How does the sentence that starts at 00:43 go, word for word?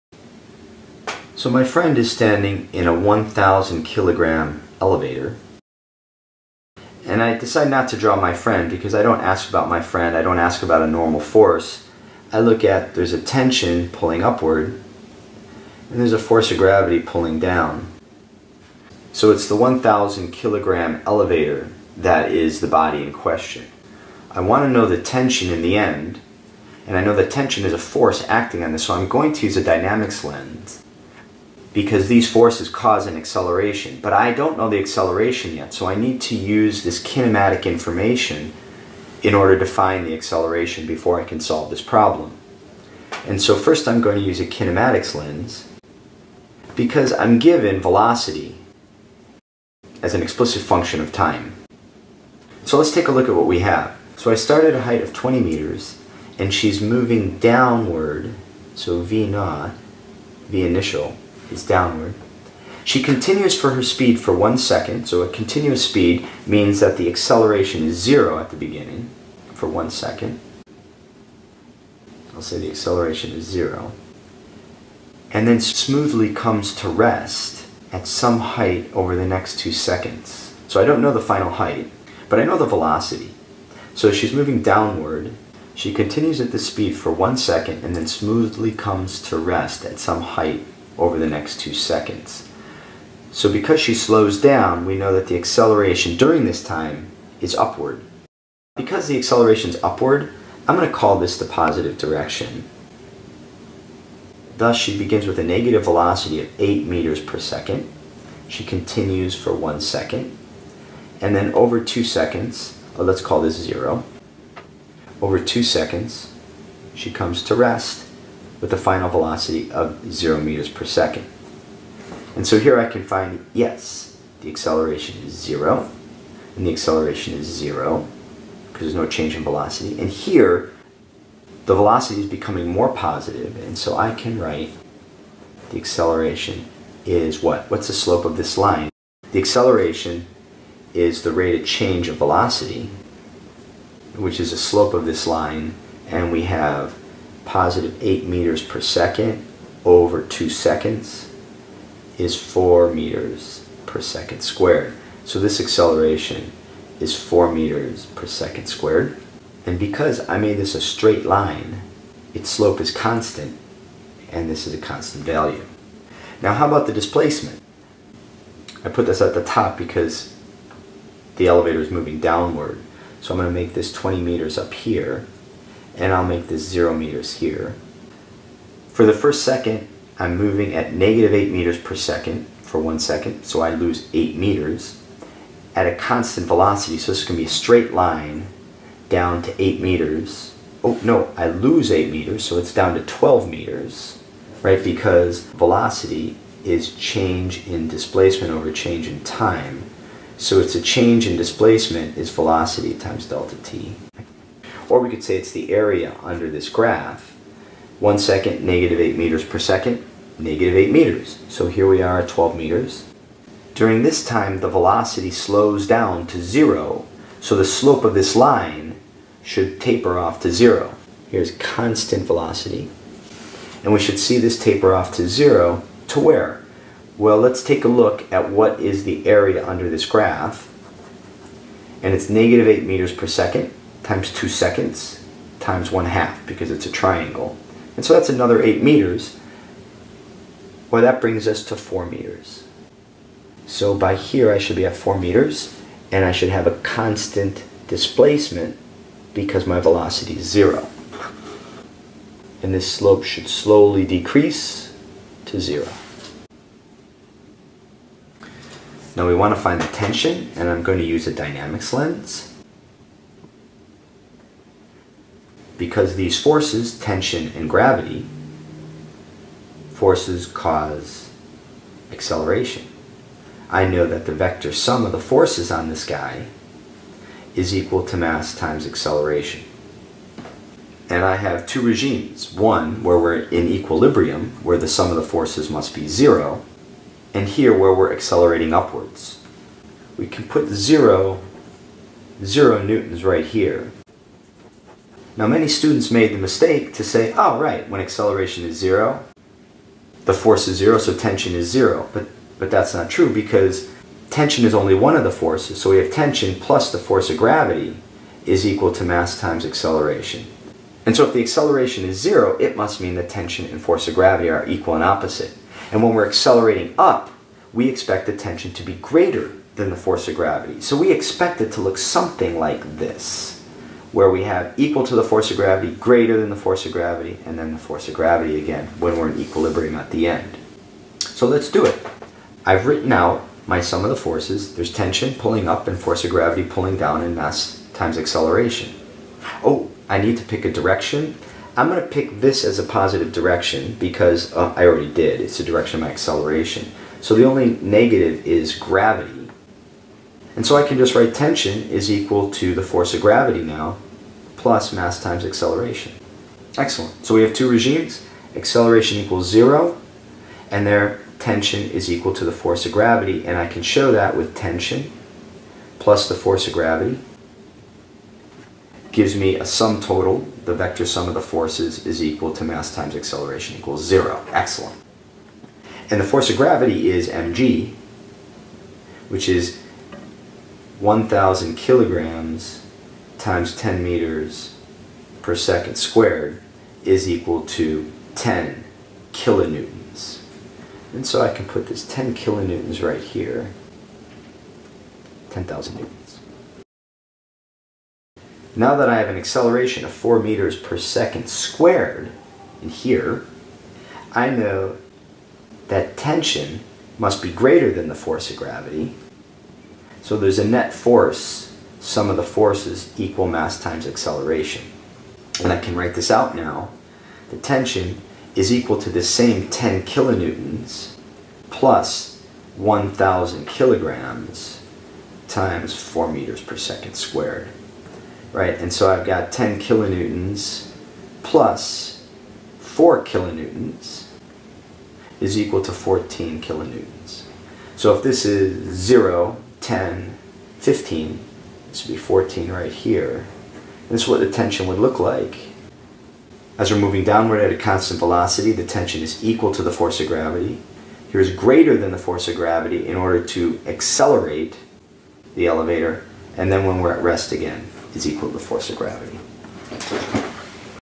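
And so first I'm going to use a kinematics lens because I'm given velocity as an explicit function of time.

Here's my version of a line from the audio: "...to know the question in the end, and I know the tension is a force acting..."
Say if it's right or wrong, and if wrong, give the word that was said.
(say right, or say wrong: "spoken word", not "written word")
wrong: "tension", not "question".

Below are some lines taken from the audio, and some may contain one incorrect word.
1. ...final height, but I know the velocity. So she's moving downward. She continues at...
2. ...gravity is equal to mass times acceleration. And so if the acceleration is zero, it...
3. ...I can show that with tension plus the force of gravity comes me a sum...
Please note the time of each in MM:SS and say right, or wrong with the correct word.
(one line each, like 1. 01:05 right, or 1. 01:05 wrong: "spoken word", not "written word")
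1. 01:21 right
2. 05:07 right
3. 06:03 wrong: "gives", not "comes".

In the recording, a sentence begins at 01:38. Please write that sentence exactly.
Because the acceleration is upward, I'm going to call this the positive direction.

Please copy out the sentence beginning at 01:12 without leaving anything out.
I'll say the acceleration is zero.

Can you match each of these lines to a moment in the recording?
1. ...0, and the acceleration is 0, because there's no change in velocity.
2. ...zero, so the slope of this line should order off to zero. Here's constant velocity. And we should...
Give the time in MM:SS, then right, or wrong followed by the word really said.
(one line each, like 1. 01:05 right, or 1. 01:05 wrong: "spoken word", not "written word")
1. 02:05 right
2. 03:36 wrong: "taper", not "order".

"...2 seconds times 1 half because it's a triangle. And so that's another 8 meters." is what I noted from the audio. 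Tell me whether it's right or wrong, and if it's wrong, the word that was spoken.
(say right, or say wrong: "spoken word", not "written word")
right.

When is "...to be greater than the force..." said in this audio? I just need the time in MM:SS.
05:18.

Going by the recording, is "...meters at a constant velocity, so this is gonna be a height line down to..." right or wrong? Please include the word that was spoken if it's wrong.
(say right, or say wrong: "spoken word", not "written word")
wrong: "straight", not "height".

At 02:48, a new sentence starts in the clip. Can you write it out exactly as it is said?
I put this at the top because the elevator is moving downward.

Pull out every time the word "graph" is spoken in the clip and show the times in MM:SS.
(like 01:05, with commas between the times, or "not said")
03:26, 03:50.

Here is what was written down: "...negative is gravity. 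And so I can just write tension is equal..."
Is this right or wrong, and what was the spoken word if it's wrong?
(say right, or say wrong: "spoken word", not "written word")
right.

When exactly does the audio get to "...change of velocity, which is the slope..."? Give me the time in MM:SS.
02:21.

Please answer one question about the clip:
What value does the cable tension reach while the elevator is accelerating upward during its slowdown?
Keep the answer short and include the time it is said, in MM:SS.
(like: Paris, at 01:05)
14 kilonewtons, at 07:15.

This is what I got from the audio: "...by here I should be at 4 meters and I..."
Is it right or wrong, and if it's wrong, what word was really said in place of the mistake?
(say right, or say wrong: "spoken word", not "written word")
right.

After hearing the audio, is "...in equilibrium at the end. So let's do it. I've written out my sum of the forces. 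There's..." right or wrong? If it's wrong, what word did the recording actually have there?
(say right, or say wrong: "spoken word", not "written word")
right.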